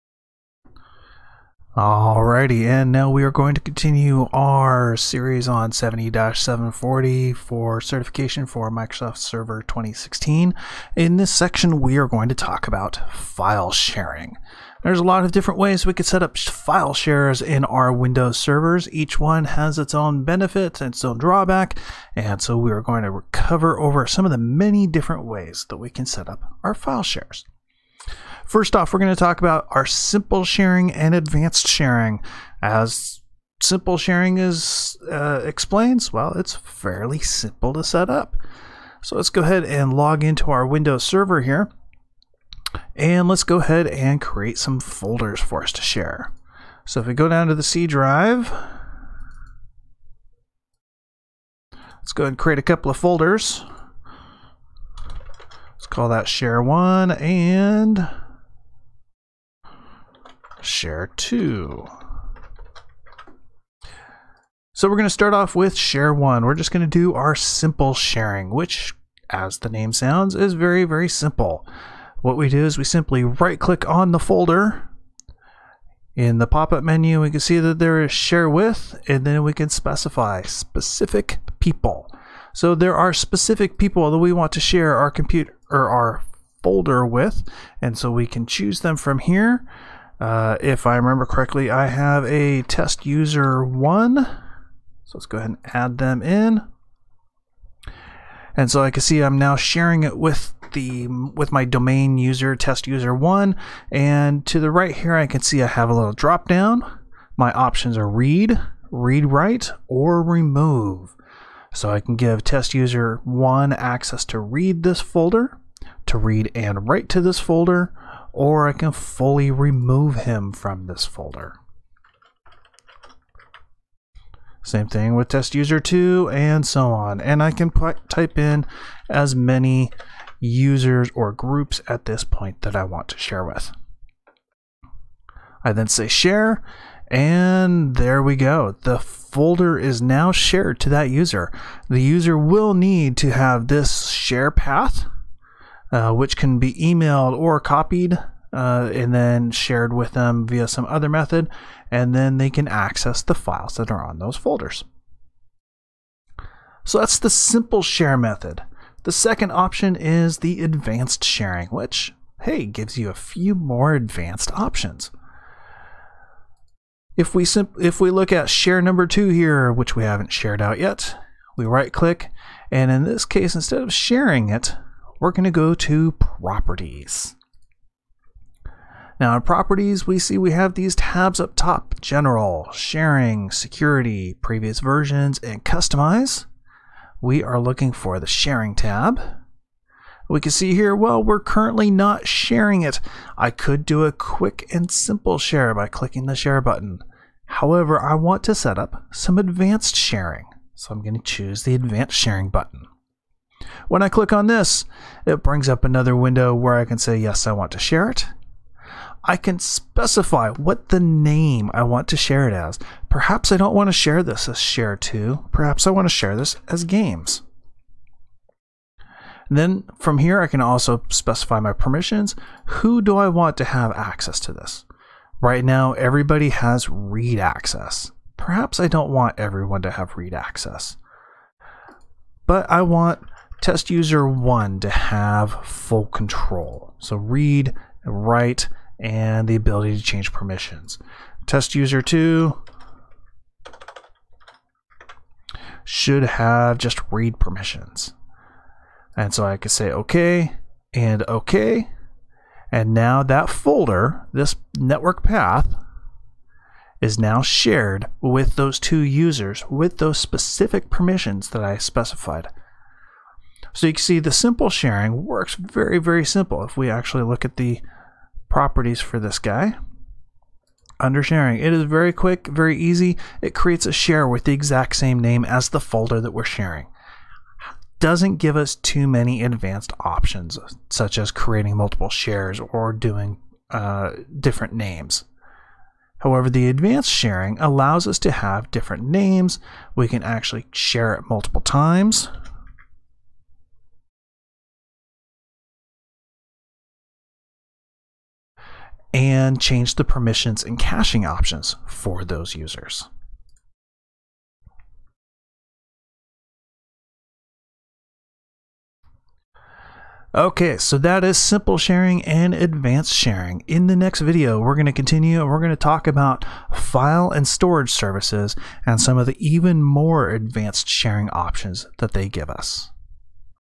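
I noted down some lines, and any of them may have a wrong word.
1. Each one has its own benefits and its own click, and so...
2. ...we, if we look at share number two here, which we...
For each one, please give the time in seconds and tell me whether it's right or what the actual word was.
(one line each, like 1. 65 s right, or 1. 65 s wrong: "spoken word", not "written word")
1. 18 s wrong: "drawback", not "click"
2. 167 s right.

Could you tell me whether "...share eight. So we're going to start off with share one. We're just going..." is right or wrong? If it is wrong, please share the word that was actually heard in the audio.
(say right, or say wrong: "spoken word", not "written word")
wrong: "two", not "eight".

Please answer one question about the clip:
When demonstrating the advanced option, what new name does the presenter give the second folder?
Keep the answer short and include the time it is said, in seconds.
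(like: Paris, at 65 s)
games, at 216 s.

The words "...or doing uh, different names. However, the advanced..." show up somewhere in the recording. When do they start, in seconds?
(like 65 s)
282 s.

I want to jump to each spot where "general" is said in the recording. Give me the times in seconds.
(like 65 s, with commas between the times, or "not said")
182 s.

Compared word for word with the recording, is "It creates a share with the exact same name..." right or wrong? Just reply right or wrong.
right.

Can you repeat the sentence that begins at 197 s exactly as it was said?
However, I want to set up some advanced sharing.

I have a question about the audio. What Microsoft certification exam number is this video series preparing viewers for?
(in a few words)
70-740.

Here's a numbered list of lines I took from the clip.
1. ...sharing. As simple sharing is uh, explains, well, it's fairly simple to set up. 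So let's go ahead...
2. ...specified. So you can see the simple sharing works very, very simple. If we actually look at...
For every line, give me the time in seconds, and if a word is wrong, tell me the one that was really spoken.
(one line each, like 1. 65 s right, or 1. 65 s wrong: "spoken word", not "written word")
1. 31 s right
2. 261 s right.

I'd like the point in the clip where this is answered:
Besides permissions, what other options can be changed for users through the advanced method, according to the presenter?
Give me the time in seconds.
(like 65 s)
300 s.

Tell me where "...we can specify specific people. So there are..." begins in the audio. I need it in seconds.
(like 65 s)
79 s.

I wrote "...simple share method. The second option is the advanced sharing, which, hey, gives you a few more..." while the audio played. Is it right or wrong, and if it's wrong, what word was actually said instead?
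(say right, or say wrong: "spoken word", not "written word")
right.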